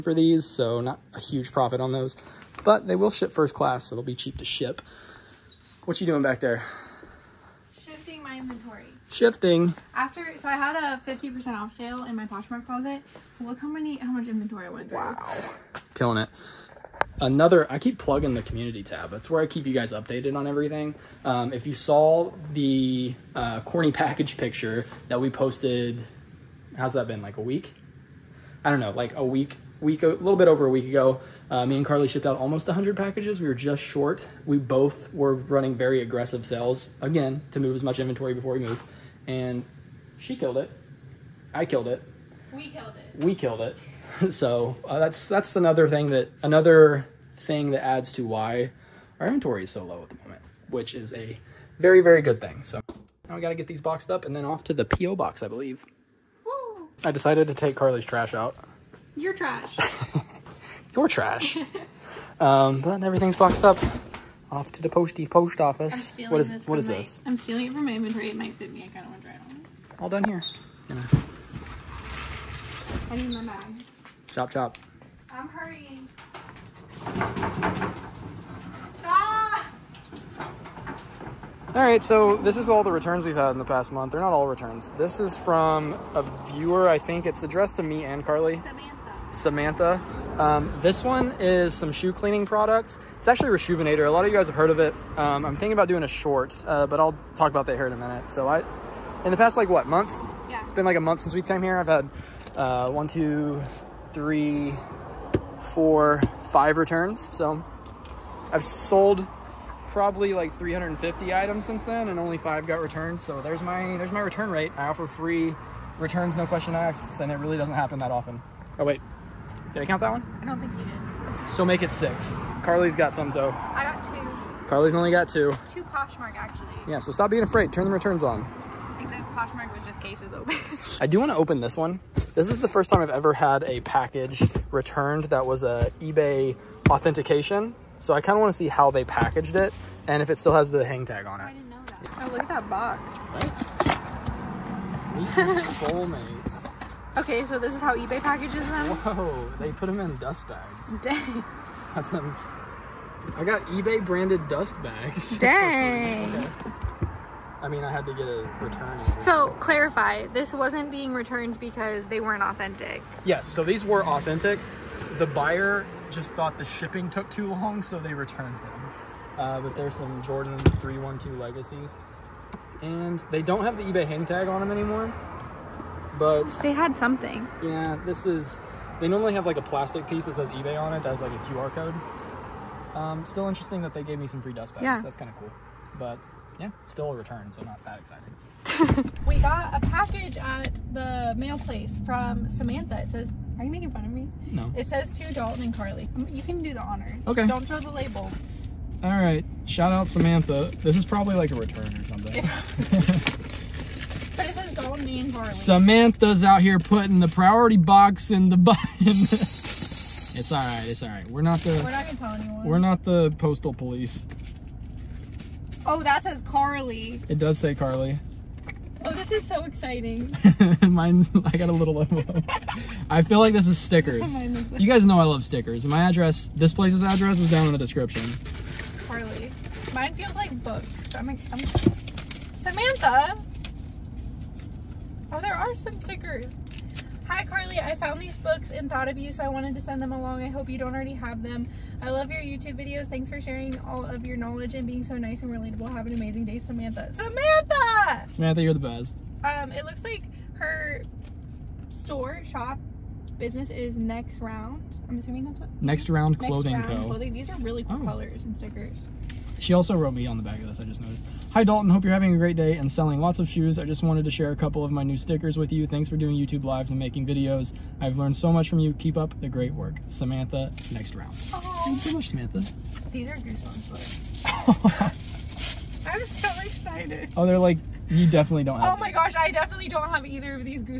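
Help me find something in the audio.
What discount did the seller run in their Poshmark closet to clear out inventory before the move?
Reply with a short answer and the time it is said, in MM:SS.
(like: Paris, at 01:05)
50% off, at 00:11.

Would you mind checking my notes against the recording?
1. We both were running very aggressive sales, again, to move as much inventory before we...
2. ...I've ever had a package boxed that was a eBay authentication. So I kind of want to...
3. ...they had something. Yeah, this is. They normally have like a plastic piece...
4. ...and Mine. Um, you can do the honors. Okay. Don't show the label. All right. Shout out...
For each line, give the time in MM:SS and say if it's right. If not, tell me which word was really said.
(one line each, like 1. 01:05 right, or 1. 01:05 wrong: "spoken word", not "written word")
1. 00:34 right
2. 02:13 wrong: "returned", not "boxed"
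3. 02:56 right
4. 03:15 wrong: "Carli", not "Mine".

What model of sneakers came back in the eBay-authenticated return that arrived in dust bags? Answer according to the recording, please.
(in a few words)
Jordan 312 Legacies.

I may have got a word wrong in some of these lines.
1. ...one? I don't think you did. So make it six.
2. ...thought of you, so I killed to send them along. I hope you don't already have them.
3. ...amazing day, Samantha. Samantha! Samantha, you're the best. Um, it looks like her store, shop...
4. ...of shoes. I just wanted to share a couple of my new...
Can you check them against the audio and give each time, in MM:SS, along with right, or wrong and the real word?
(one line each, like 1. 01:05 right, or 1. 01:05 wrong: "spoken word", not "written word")
1. 02:00 right
2. 03:58 wrong: "wanted", not "killed"
3. 04:06 right
4. 04:23 right.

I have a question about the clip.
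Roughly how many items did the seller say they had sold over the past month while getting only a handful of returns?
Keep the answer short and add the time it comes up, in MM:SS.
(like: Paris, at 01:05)
350, at 01:50.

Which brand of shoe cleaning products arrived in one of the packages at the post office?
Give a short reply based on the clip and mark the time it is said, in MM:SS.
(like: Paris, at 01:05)
Reshoevn8r, at 01:33.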